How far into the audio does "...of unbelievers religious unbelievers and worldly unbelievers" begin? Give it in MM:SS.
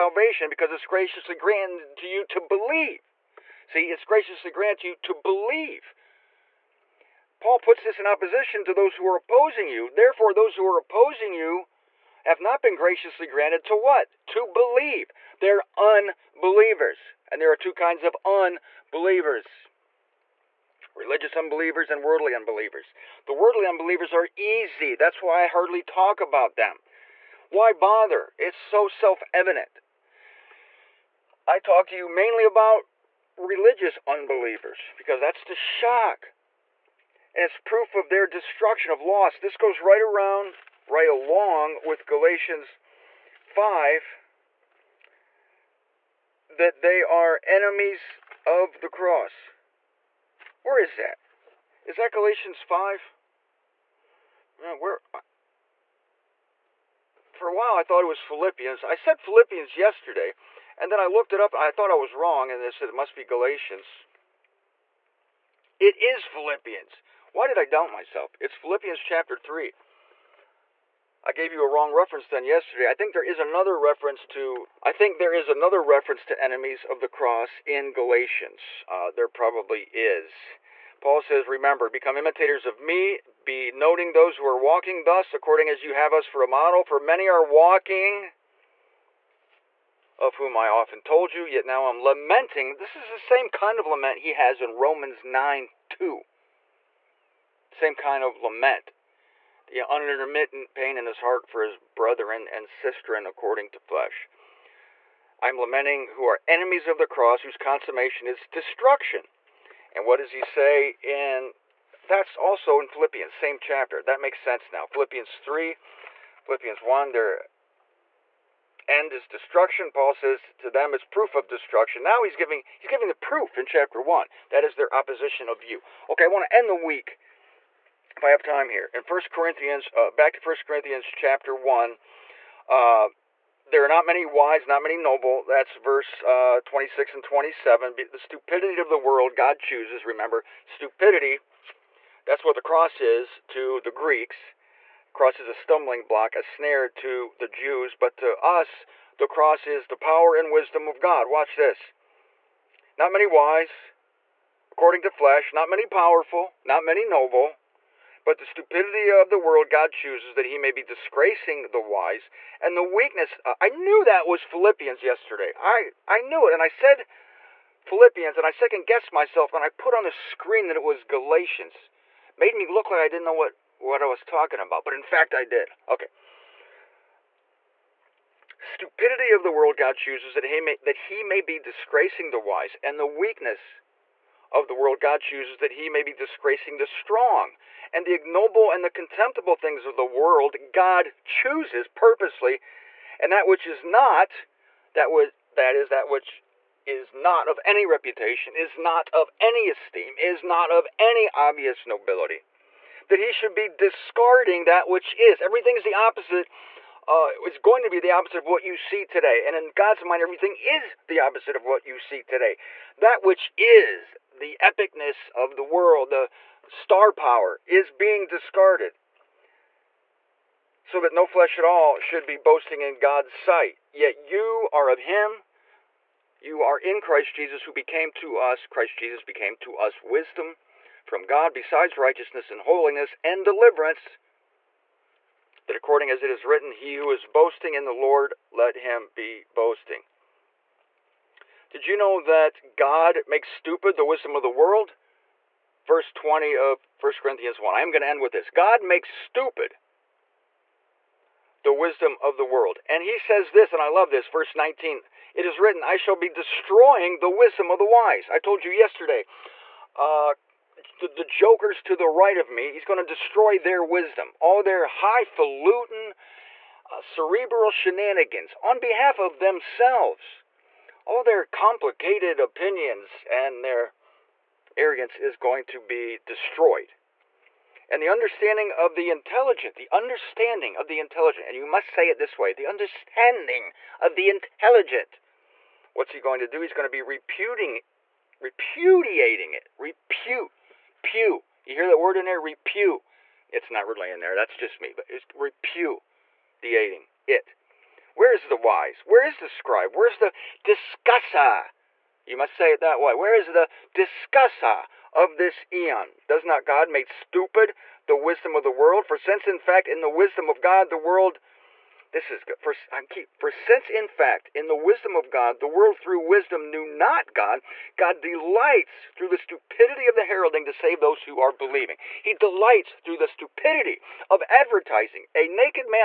00:18.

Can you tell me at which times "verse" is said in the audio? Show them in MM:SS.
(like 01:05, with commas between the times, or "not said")
02:15, 04:05, 04:14.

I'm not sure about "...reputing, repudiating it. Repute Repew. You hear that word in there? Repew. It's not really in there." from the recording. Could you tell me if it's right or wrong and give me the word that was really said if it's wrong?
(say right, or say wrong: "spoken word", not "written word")
right.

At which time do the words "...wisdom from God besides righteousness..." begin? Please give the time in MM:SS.
03:50.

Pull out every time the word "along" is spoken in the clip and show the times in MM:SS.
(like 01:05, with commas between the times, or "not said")
00:41.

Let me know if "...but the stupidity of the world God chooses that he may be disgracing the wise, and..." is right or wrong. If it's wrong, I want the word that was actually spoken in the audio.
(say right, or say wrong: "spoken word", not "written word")
right.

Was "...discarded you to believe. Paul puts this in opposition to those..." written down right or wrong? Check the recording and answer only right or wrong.
wrong.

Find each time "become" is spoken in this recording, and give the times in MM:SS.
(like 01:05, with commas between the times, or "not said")
01:21.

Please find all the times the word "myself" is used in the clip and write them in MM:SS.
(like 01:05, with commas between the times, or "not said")
01:07, 02:49.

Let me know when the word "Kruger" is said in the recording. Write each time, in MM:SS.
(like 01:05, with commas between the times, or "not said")
not said.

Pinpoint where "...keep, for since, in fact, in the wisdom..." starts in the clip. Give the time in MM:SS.
05:13.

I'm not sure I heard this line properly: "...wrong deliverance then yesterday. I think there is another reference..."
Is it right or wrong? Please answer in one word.
wrong.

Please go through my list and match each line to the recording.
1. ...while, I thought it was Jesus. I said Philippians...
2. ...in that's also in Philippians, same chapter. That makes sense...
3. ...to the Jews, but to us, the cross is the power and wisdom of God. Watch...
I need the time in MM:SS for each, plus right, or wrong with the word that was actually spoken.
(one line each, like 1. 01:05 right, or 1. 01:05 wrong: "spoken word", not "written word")
1. 00:57 wrong: "Philippians", not "Jesus"
2. 01:51 right
3. 02:26 right.